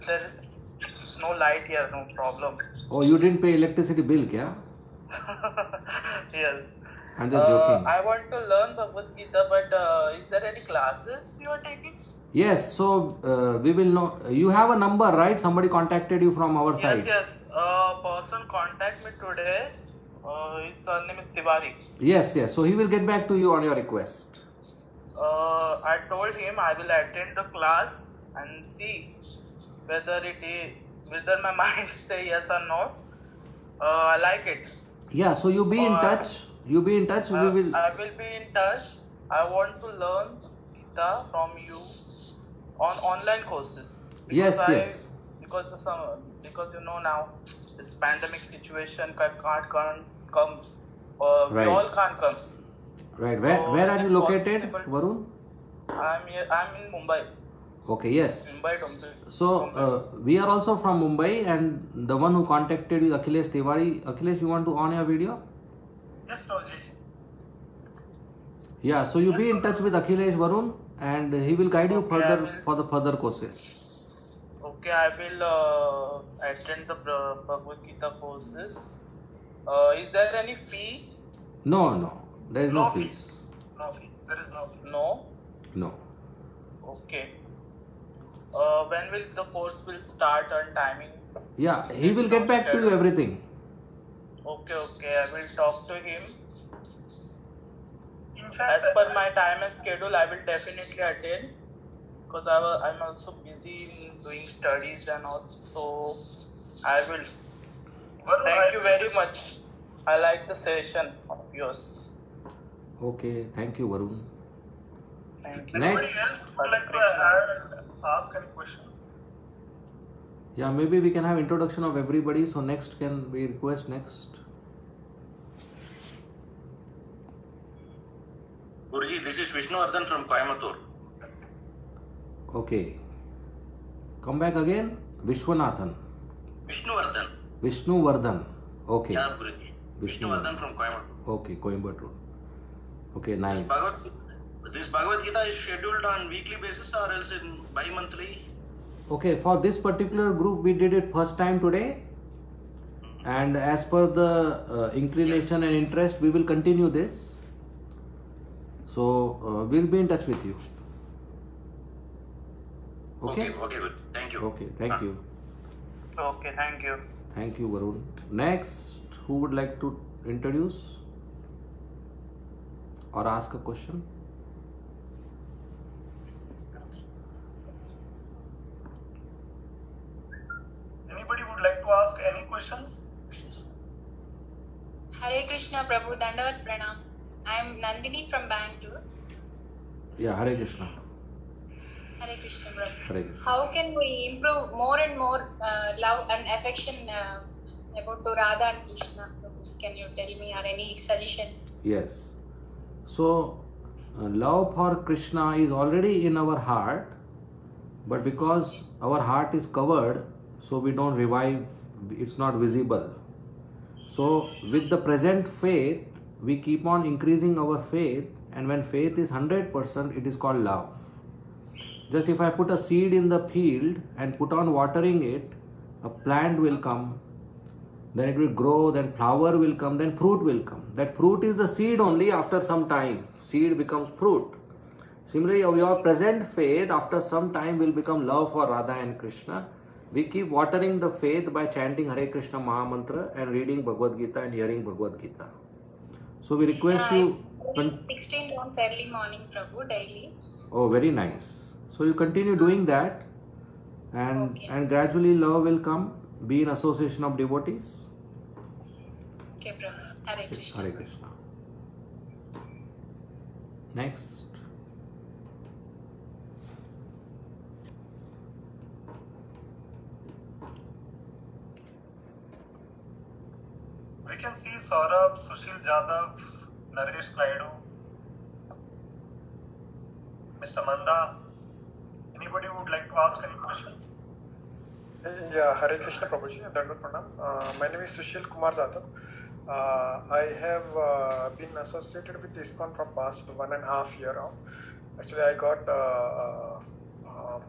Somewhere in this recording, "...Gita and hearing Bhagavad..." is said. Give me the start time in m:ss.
4:04.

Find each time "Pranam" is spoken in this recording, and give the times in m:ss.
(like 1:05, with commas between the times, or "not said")
3:06, 4:46.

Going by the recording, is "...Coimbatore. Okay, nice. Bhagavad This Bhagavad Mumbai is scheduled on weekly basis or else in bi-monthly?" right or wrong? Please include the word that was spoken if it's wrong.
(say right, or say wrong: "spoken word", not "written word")
wrong: "Gita", not "Mumbai".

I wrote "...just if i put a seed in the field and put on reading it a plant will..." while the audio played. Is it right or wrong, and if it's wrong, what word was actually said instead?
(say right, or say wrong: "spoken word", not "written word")
wrong: "watering", not "reading".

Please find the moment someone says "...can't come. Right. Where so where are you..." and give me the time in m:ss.
0:51.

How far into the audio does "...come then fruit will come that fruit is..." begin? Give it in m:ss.
3:49.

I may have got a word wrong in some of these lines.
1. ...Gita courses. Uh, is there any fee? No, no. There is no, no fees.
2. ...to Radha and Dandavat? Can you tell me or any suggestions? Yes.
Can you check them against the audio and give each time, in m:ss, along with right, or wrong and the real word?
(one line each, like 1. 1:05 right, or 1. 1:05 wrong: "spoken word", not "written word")
1. 1:17 right
2. 3:18 wrong: "Krishna", not "Dandavat".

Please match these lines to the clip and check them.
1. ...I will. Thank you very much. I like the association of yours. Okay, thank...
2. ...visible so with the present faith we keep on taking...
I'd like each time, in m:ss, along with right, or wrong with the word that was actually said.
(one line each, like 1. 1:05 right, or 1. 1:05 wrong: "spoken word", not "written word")
1. 1:46 wrong: "session", not "association"
2. 3:32 wrong: "increasing", not "taking".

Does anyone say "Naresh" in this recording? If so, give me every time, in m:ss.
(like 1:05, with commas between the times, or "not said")
4:36.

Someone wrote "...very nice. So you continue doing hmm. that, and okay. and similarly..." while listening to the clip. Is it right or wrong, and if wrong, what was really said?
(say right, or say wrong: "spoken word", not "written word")
wrong: "gradually", not "similarly".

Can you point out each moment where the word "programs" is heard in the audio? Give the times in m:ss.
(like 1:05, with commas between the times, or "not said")
not said.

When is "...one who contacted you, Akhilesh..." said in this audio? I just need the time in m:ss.
1:02.